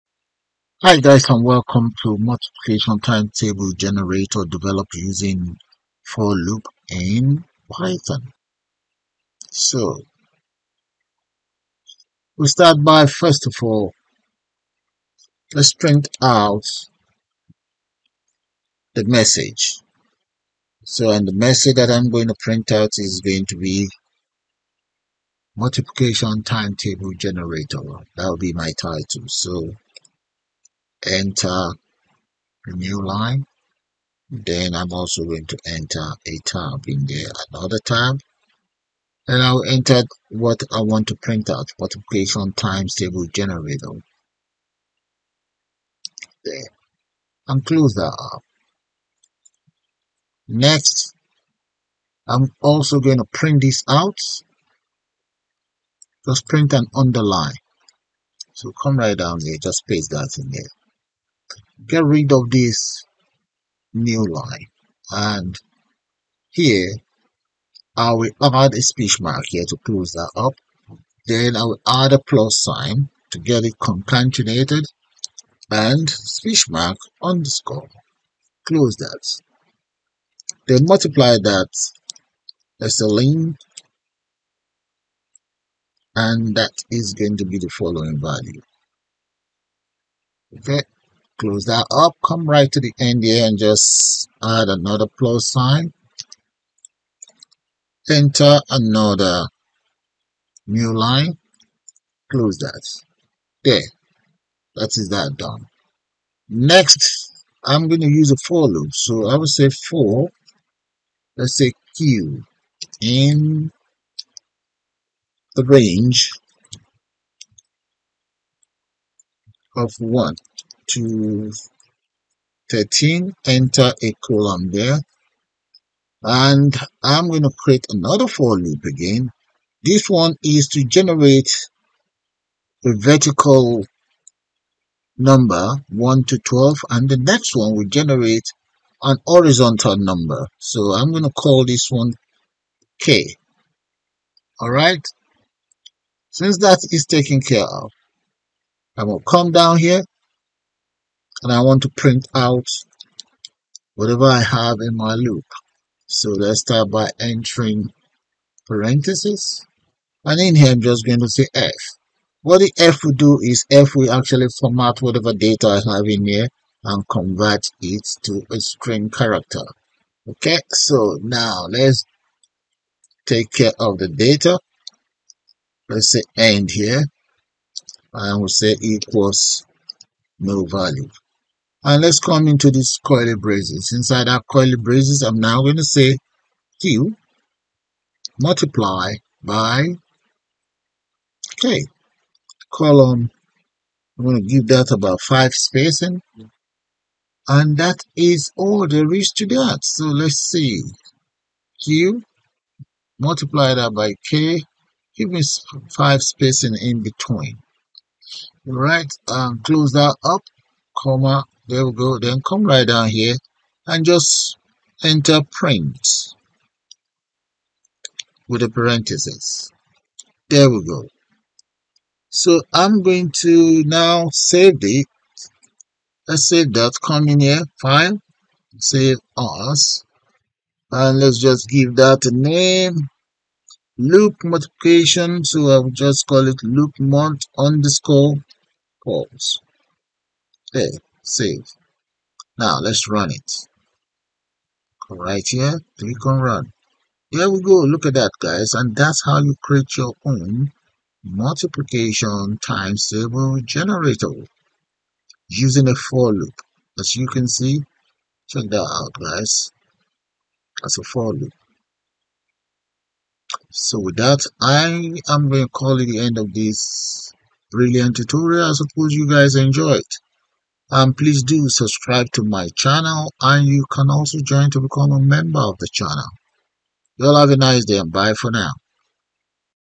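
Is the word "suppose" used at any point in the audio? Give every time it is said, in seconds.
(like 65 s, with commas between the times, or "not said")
268 s.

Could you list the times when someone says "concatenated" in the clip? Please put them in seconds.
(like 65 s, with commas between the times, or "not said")
73 s.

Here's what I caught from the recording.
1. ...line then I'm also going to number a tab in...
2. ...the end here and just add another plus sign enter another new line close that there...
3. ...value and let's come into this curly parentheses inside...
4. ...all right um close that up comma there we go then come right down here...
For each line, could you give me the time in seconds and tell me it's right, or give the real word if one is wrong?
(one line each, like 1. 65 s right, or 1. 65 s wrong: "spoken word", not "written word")
1. 33 s wrong: "enter", not "number"
2. 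92 s right
3. 180 s wrong: "braces", not "parentheses"
4. 208 s right.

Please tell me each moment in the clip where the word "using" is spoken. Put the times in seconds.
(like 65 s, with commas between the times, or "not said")
4 s, 255 s.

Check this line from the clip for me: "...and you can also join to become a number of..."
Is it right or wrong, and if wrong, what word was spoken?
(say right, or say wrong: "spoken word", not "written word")
wrong: "member", not "number".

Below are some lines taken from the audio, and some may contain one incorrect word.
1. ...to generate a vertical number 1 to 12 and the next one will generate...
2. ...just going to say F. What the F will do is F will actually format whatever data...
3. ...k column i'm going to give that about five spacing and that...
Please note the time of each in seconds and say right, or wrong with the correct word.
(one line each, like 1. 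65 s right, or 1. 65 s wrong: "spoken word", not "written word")
1. 130 s right
2. 160 s right
3. 191 s right.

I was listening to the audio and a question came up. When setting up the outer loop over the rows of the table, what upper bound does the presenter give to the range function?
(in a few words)
13.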